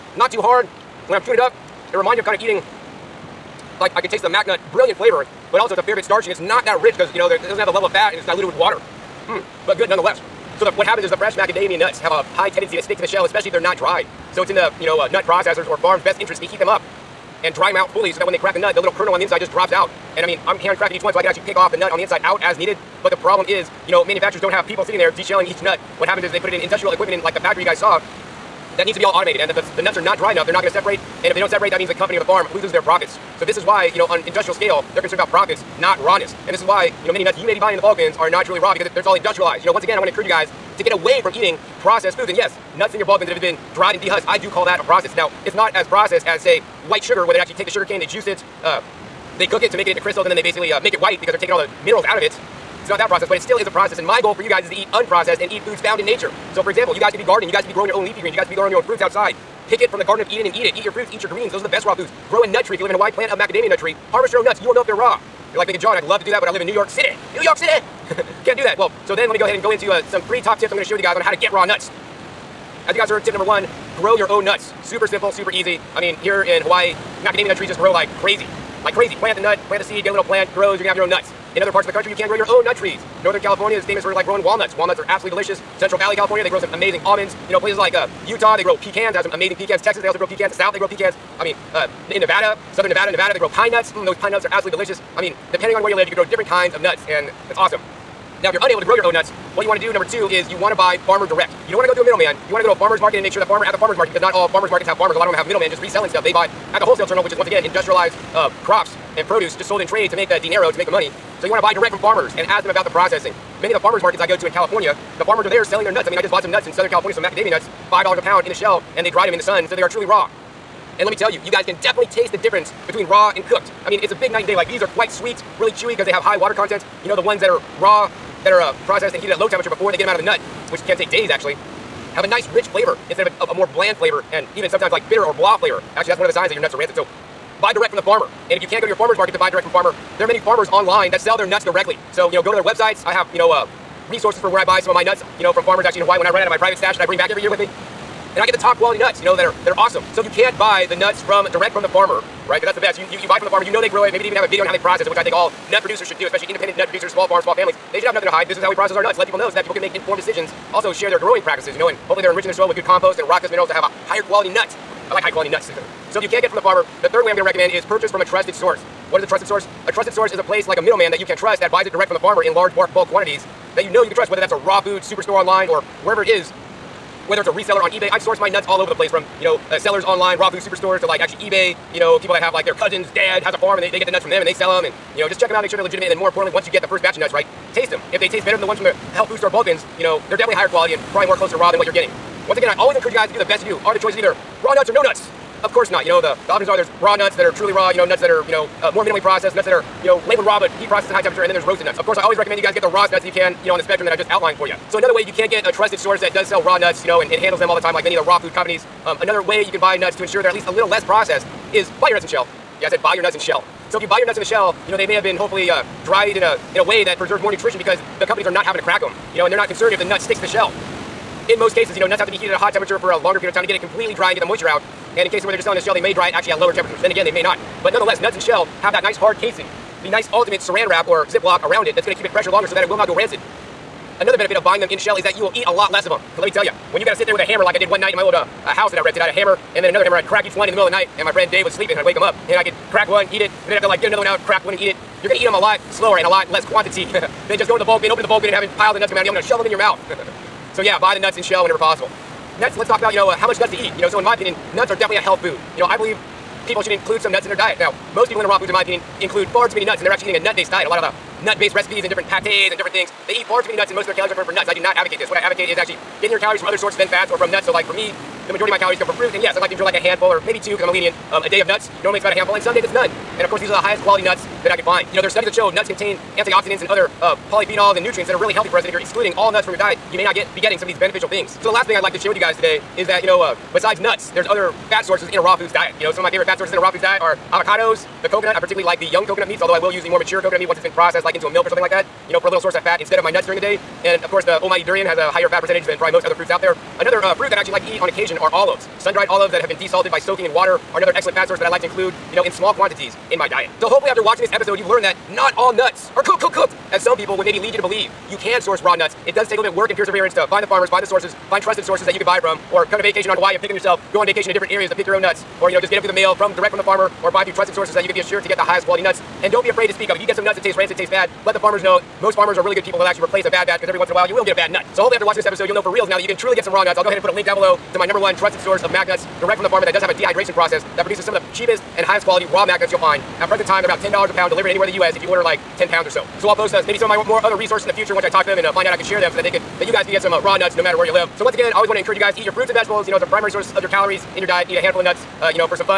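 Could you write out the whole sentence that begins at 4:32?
Normally it's about a handful and some days it's none.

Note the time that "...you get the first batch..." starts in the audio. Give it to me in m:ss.
3:06.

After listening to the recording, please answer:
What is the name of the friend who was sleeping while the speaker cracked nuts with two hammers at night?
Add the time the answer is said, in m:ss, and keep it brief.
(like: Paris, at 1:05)
Dave, at 4:01.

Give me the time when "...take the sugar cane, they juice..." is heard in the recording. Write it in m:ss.
0:47.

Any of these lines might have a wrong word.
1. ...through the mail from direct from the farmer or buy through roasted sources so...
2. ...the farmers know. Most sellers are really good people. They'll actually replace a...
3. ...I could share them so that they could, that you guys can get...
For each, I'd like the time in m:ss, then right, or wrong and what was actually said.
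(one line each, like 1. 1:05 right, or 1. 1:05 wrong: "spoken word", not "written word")
1. 5:16 wrong: "trusted", not "roasted"
2. 5:21 wrong: "farmers", not "sellers"
3. 5:38 right.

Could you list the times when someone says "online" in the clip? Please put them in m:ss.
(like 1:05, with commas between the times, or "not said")
2:20, 2:55, 3:00.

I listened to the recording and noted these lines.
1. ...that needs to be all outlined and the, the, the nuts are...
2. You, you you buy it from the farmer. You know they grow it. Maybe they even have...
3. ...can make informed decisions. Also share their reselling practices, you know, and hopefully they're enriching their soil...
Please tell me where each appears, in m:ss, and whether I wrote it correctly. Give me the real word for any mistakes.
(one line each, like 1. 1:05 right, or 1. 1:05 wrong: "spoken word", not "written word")
1. 0:28 wrong: "automated", not "outlined"
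2. 2:32 right
3. 2:39 wrong: "growing", not "reselling".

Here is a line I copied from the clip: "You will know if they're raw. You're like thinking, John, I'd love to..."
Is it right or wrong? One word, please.
right.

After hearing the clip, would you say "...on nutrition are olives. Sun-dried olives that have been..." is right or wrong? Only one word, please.
wrong.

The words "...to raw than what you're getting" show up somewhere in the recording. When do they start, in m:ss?
3:11.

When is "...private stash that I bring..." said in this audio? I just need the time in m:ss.
2:26.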